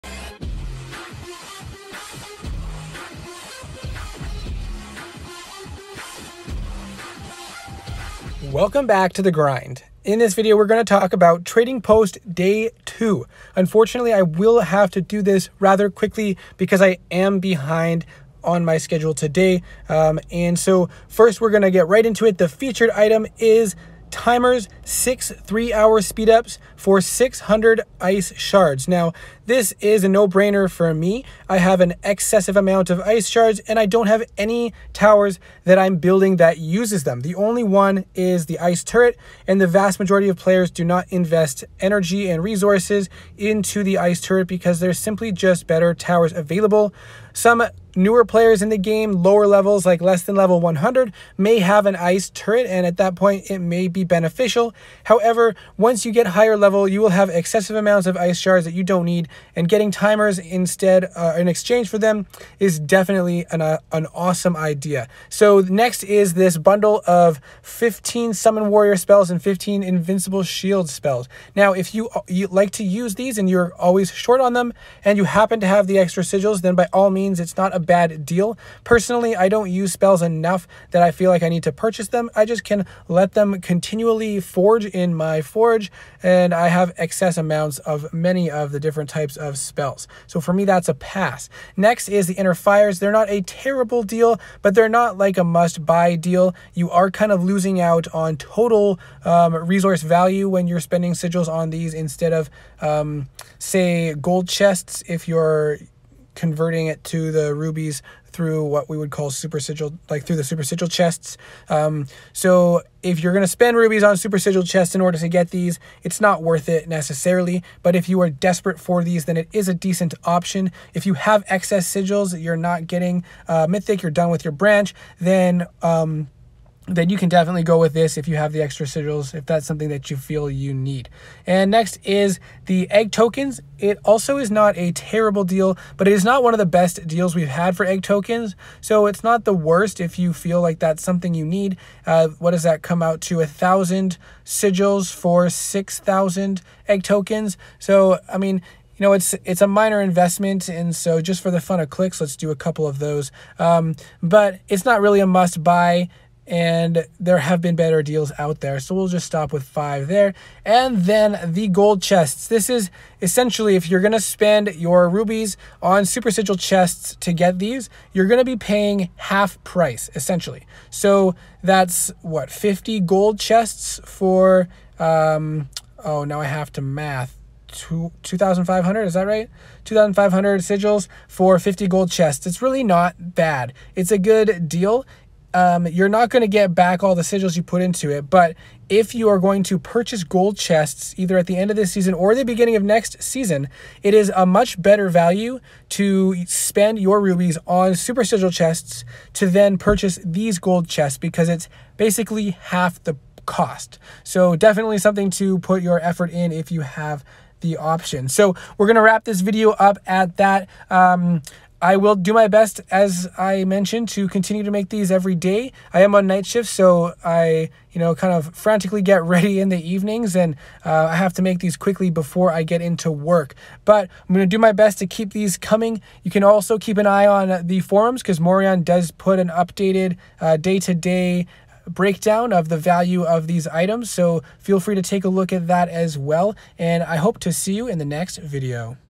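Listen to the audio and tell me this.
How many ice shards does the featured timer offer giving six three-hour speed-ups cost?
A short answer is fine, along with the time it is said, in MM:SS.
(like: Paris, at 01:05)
600, at 00:27.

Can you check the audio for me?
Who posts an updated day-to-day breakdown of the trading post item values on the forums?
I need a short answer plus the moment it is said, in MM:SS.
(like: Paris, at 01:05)
Morion, at 03:48.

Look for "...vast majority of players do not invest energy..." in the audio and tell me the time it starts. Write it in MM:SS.
00:39.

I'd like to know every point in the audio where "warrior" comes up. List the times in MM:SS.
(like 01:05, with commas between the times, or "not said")
01:08.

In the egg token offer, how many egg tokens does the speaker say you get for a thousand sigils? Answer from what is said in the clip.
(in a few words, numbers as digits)
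6,000.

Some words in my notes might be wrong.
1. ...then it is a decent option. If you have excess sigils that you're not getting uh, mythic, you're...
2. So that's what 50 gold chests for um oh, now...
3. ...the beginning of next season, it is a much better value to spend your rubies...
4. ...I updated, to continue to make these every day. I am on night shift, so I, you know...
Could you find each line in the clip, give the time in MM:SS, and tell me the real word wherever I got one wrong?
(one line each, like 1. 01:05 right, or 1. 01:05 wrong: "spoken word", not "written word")
1. 01:59 right
2. 02:50 right
3. 03:12 right
4. 03:33 wrong: "mentioned", not "updated".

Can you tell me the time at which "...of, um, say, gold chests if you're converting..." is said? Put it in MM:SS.
01:42.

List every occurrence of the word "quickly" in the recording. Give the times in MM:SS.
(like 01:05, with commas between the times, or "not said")
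00:15, 03:41.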